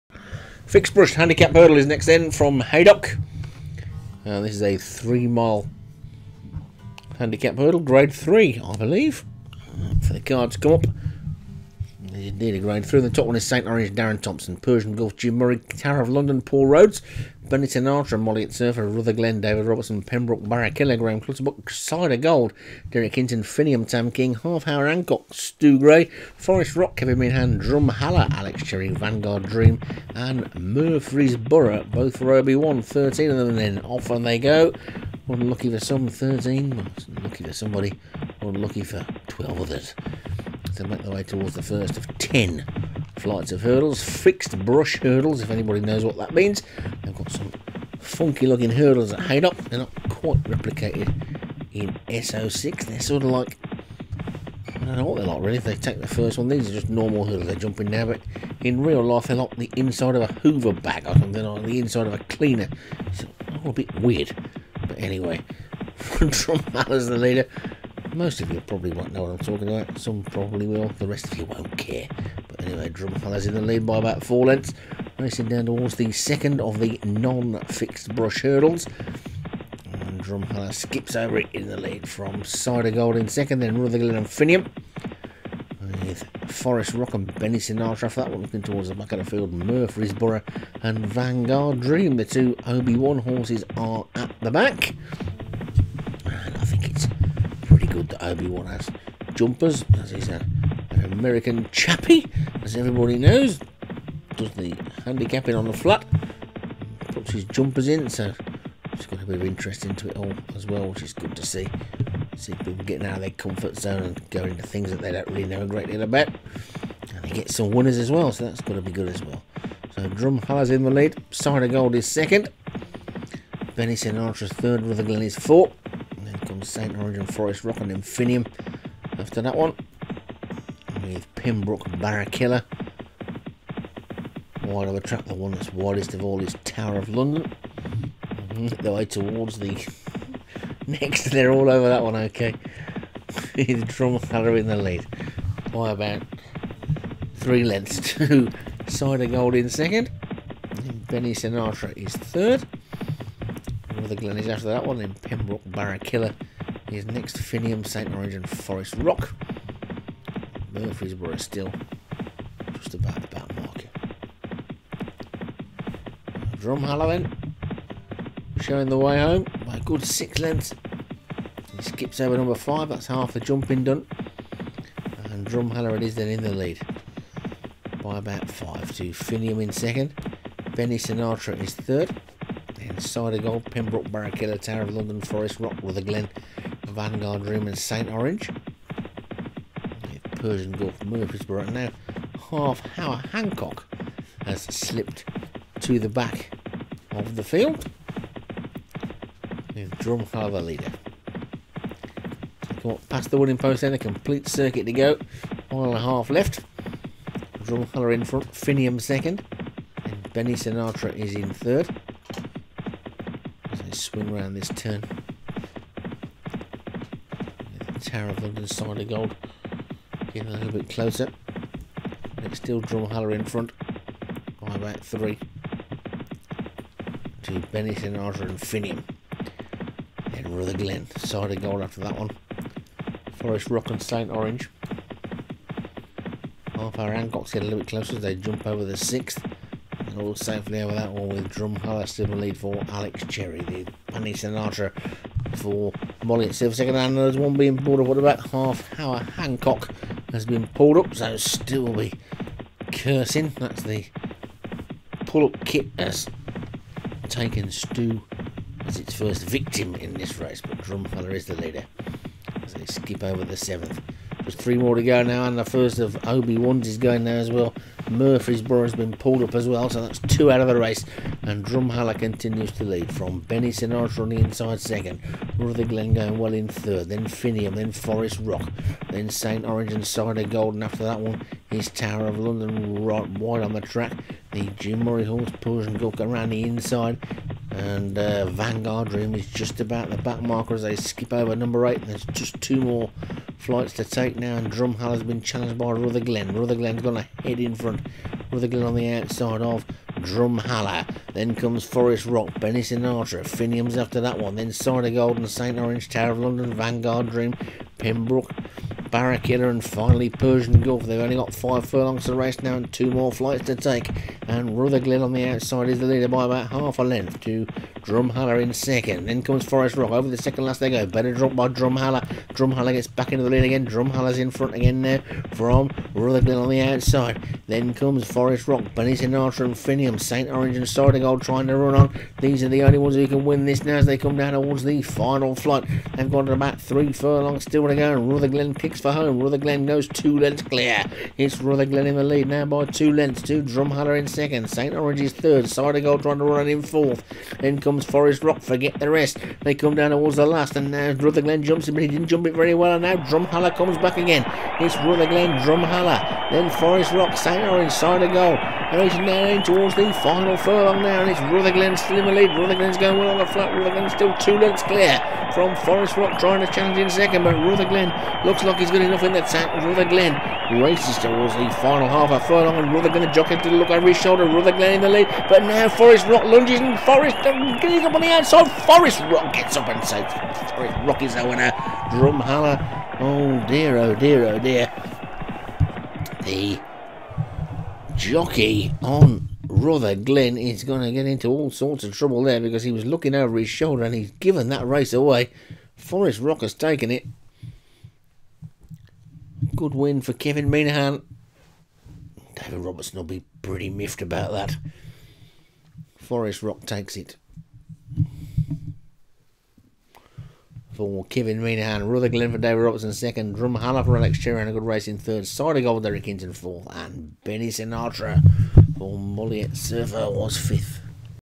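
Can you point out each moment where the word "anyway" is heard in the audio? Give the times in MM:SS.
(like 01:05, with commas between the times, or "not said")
01:04, 01:12.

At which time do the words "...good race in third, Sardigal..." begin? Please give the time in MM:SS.
06:54.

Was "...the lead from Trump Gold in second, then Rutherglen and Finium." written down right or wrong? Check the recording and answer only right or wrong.
wrong.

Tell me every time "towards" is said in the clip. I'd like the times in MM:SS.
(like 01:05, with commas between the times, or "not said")
00:41, 01:15, 01:28, 02:19, 05:34, 05:50, 05:59, 06:11.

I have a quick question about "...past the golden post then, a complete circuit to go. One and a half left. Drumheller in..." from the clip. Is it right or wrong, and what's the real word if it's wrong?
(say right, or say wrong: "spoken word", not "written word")
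wrong: "wooden", not "golden".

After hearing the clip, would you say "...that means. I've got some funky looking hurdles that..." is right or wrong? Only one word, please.
right.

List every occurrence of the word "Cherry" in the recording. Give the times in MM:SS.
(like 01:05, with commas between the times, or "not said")
00:28, 04:03, 06:54.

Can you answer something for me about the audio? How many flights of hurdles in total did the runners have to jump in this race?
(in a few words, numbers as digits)
10.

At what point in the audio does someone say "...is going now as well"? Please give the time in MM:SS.
04:26.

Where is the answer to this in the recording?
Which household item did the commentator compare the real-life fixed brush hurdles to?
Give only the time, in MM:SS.
00:59.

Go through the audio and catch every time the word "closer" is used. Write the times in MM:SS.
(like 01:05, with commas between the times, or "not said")
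03:40, 03:57.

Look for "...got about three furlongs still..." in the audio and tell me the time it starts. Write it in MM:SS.
05:36.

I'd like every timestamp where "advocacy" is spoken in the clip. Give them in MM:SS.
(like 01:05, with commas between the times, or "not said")
not said.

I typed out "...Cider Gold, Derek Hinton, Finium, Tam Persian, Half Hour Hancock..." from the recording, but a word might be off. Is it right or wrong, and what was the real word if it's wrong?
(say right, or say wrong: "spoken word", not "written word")
wrong: "King", not "Persian".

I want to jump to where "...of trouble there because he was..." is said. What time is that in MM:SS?
06:32.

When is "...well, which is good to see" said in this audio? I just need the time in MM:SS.
01:50.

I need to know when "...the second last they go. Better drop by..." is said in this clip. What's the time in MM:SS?
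05:20.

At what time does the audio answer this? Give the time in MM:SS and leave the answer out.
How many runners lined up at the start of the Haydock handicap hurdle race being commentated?
00:32.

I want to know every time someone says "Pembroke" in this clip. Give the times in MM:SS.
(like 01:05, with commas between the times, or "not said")
00:20, 02:11, 02:35, 03:03, 05:07.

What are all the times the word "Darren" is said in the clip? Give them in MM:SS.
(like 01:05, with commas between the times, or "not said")
00:13.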